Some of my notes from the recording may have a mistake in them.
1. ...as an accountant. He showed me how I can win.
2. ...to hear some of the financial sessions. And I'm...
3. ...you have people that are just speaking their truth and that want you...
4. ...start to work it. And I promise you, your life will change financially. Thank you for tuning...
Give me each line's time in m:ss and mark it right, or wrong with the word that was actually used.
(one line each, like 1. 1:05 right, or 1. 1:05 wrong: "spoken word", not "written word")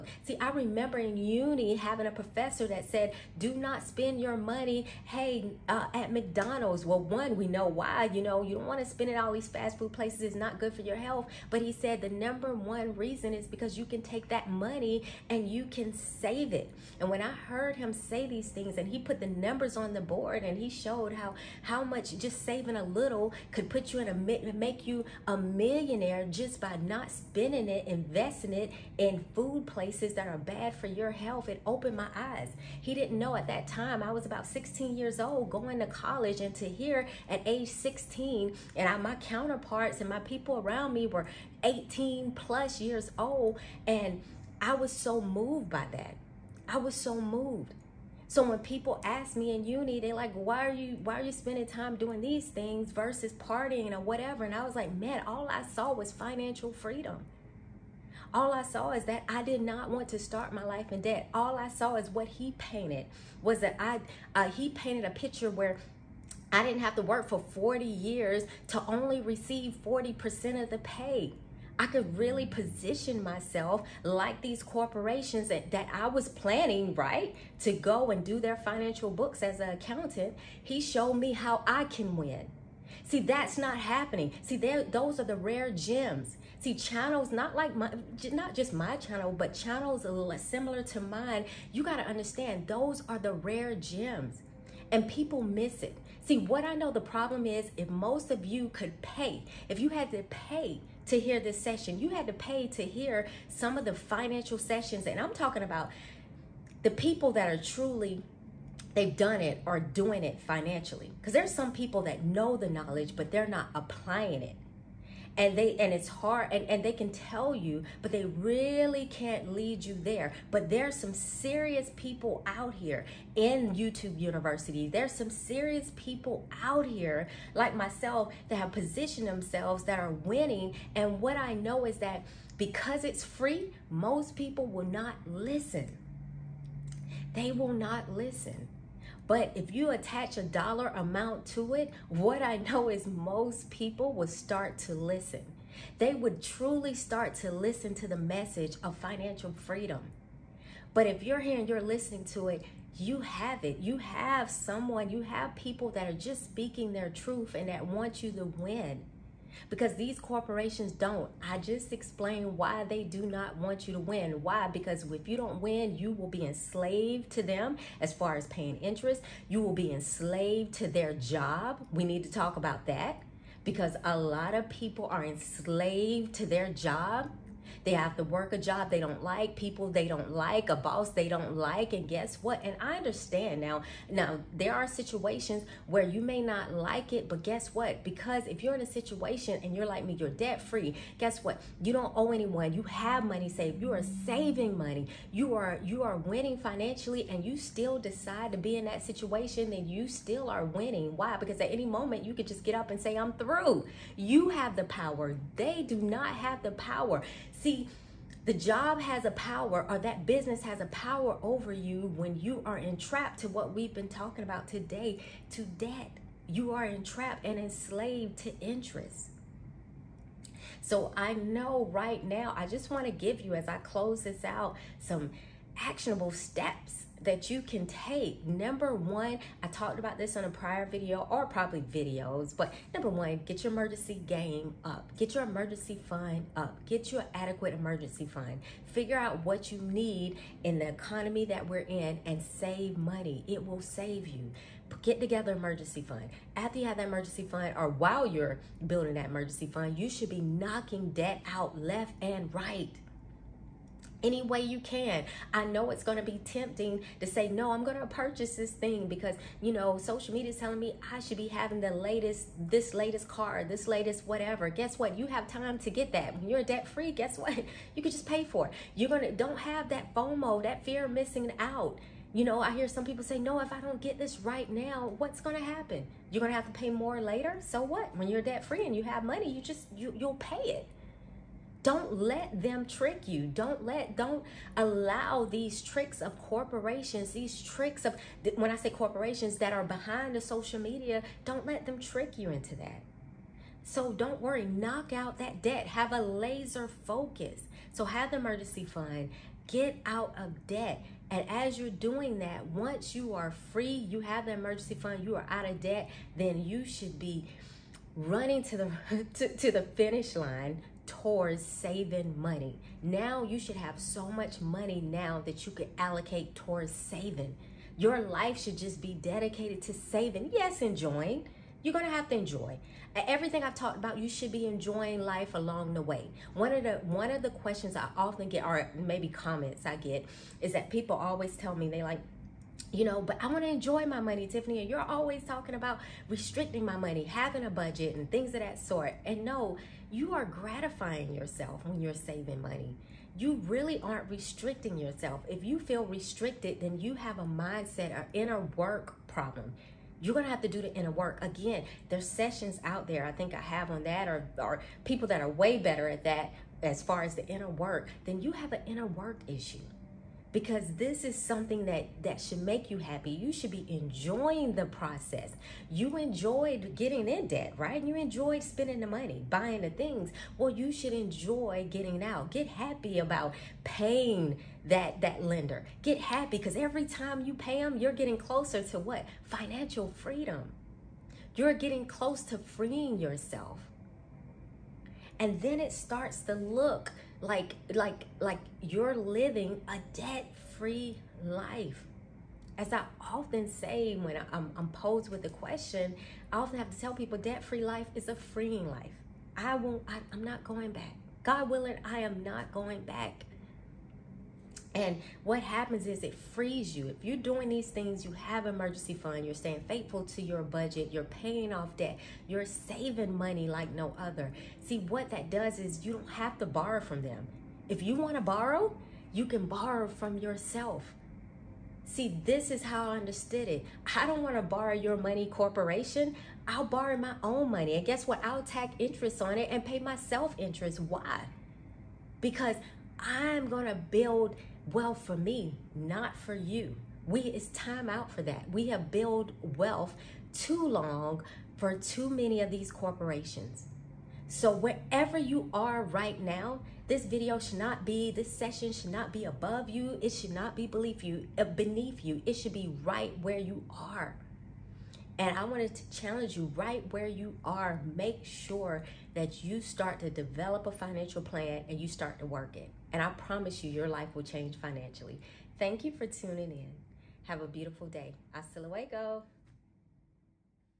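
1. 1:19 right
2. 1:42 right
3. 2:35 right
4. 7:42 right.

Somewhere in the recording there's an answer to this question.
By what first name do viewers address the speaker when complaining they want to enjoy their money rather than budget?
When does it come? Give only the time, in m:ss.
5:34.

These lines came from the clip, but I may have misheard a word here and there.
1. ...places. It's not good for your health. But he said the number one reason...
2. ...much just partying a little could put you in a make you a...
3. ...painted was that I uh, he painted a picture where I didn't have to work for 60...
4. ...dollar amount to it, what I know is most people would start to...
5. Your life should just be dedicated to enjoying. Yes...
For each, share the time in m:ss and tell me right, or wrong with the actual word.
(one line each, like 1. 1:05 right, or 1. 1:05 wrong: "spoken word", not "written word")
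1. 0:09 right
2. 0:21 wrong: "saving", not "partying"
3. 1:02 wrong: "40", not "60"
4. 2:20 right
5. 5:17 wrong: "saving", not "enjoying".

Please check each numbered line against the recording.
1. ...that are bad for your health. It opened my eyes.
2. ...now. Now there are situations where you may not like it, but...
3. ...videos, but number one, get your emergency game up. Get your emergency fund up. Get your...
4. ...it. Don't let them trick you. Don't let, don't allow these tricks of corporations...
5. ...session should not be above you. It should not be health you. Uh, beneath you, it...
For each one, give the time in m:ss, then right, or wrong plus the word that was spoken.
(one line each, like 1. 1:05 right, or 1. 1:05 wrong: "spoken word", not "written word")
1. 0:30 right
2. 3:03 right
3. 3:51 right
4. 4:40 right
5. 7:28 wrong: "beneath", not "health".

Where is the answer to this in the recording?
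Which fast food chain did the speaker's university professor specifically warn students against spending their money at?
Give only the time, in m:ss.
0:06.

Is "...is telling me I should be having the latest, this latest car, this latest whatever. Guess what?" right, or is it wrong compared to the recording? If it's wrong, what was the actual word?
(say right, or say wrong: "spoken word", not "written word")
right.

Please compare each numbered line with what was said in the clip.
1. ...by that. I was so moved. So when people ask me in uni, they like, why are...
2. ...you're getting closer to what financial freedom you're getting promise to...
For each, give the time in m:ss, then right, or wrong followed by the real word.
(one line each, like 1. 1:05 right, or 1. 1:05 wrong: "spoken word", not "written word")
1. 0:45 right
2. 6:17 wrong: "close", not "promise".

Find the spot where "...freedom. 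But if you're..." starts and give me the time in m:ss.
2:29.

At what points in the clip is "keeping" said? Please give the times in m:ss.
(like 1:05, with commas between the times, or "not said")
not said.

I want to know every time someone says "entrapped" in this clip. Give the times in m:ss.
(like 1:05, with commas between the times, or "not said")
3:32, 3:36.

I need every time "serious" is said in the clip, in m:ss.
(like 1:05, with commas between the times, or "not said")
2:01, 2:05.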